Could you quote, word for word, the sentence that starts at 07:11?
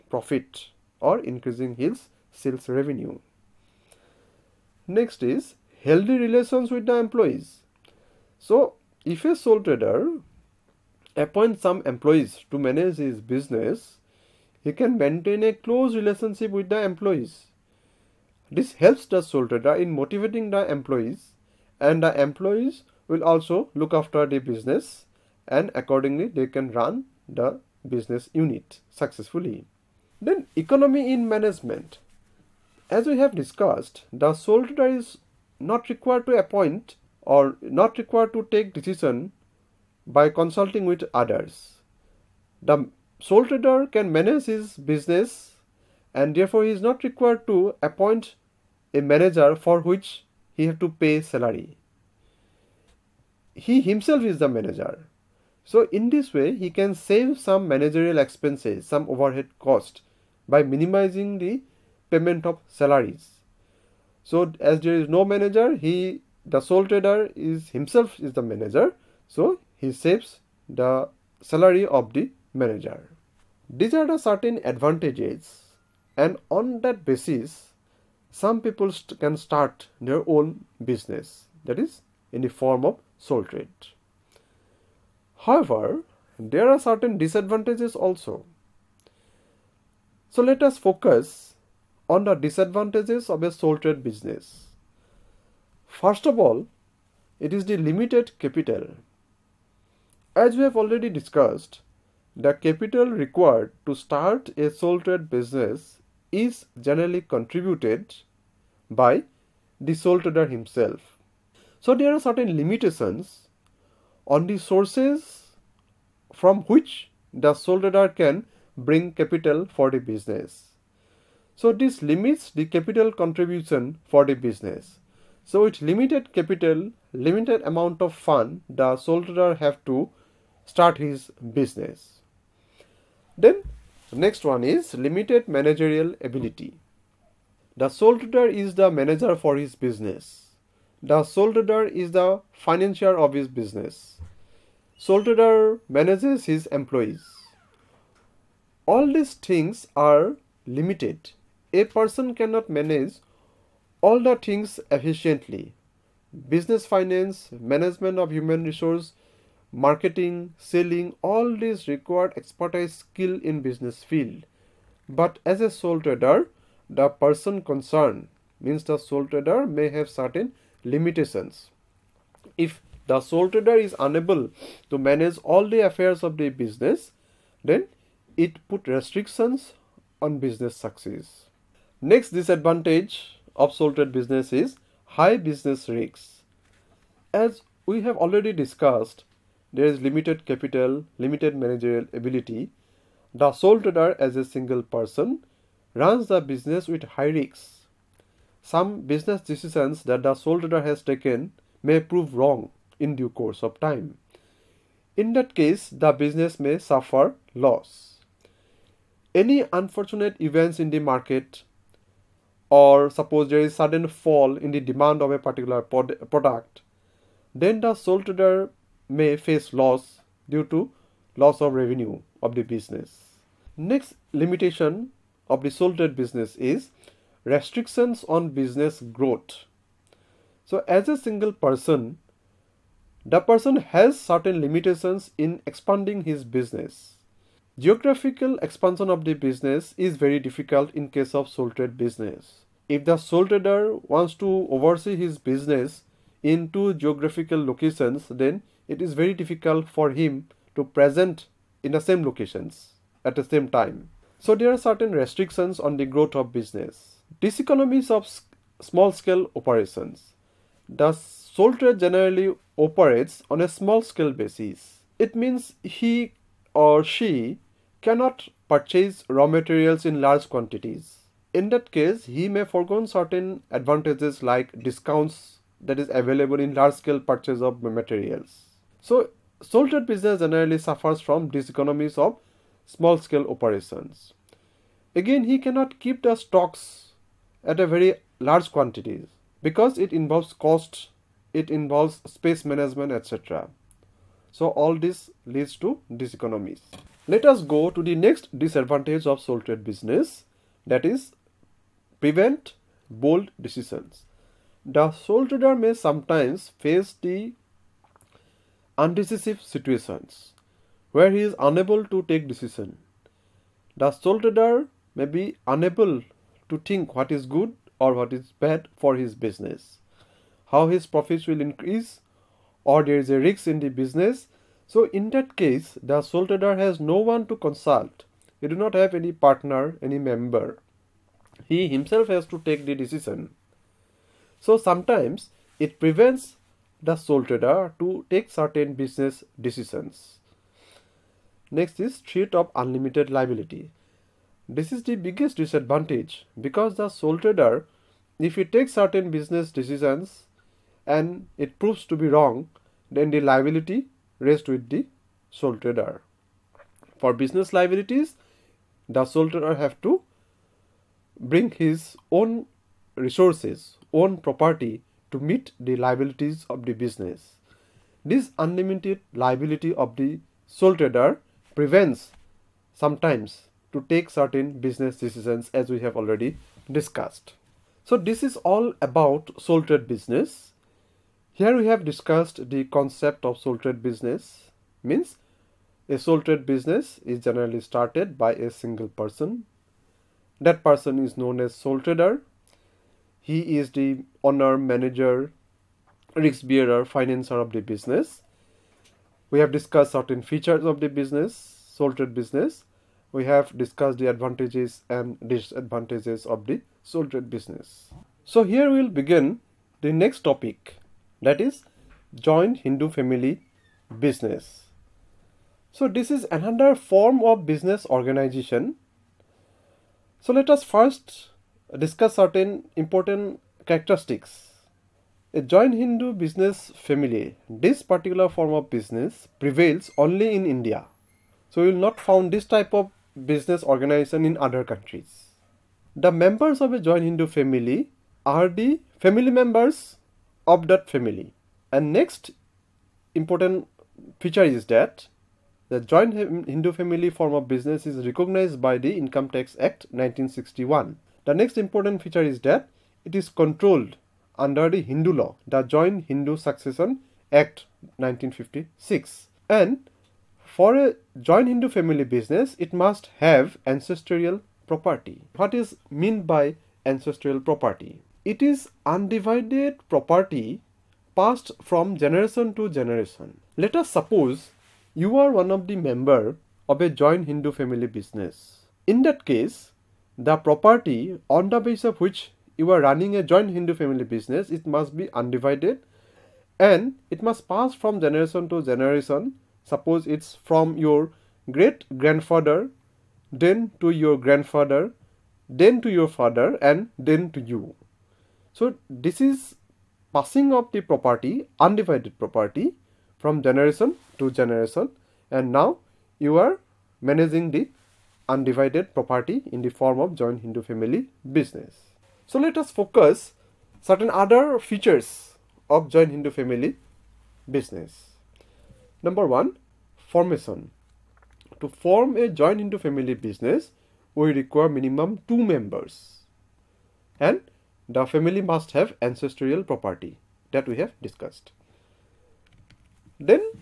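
So you will not found this type of business organization in other countries.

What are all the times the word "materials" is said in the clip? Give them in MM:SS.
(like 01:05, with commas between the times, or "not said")
04:29, 04:37.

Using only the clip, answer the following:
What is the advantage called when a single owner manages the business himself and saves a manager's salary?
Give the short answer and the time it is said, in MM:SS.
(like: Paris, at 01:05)
Economy in management, at 00:30.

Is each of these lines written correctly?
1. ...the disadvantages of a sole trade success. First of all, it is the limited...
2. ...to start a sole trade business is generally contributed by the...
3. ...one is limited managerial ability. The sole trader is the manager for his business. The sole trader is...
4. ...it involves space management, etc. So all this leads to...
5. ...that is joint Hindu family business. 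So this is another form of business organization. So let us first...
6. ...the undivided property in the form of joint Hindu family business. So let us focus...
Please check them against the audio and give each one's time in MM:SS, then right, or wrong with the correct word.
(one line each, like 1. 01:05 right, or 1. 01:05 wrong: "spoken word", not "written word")
1. 01:32 wrong: "business", not "success"
2. 01:43 right
3. 02:14 right
4. 04:51 right
5. 06:51 right
6. 08:27 right.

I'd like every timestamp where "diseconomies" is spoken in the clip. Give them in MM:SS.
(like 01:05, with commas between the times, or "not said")
04:17, 04:41, 04:56.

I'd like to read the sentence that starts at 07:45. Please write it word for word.
What is meant by ancestral property?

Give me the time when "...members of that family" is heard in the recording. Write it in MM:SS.
07:19.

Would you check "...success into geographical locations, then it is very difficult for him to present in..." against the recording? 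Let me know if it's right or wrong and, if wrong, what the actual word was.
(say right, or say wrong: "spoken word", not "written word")
wrong: "business", not "success".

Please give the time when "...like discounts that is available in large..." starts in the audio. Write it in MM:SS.
04:34.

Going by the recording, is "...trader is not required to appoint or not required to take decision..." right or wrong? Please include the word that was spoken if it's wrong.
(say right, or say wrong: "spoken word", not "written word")
right.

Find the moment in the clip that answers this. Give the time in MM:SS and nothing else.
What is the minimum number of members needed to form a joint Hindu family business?
08:45.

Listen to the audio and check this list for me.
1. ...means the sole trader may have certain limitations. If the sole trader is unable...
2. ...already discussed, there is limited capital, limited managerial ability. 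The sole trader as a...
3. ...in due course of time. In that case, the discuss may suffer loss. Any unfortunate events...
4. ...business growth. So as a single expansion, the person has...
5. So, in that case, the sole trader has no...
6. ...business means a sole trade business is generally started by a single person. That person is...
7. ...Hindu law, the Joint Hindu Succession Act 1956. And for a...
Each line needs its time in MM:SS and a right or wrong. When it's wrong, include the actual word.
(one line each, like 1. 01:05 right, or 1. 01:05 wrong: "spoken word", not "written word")
1. 02:48 right
2. 03:08 right
3. 03:22 wrong: "business", not "discuss"
4. 03:48 wrong: "person", not "expansion"
5. 05:24 right
6. 06:24 right
7. 07:35 right.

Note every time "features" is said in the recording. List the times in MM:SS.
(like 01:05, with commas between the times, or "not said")
06:40, 07:24, 07:32, 08:34.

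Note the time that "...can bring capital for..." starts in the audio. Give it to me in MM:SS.
01:58.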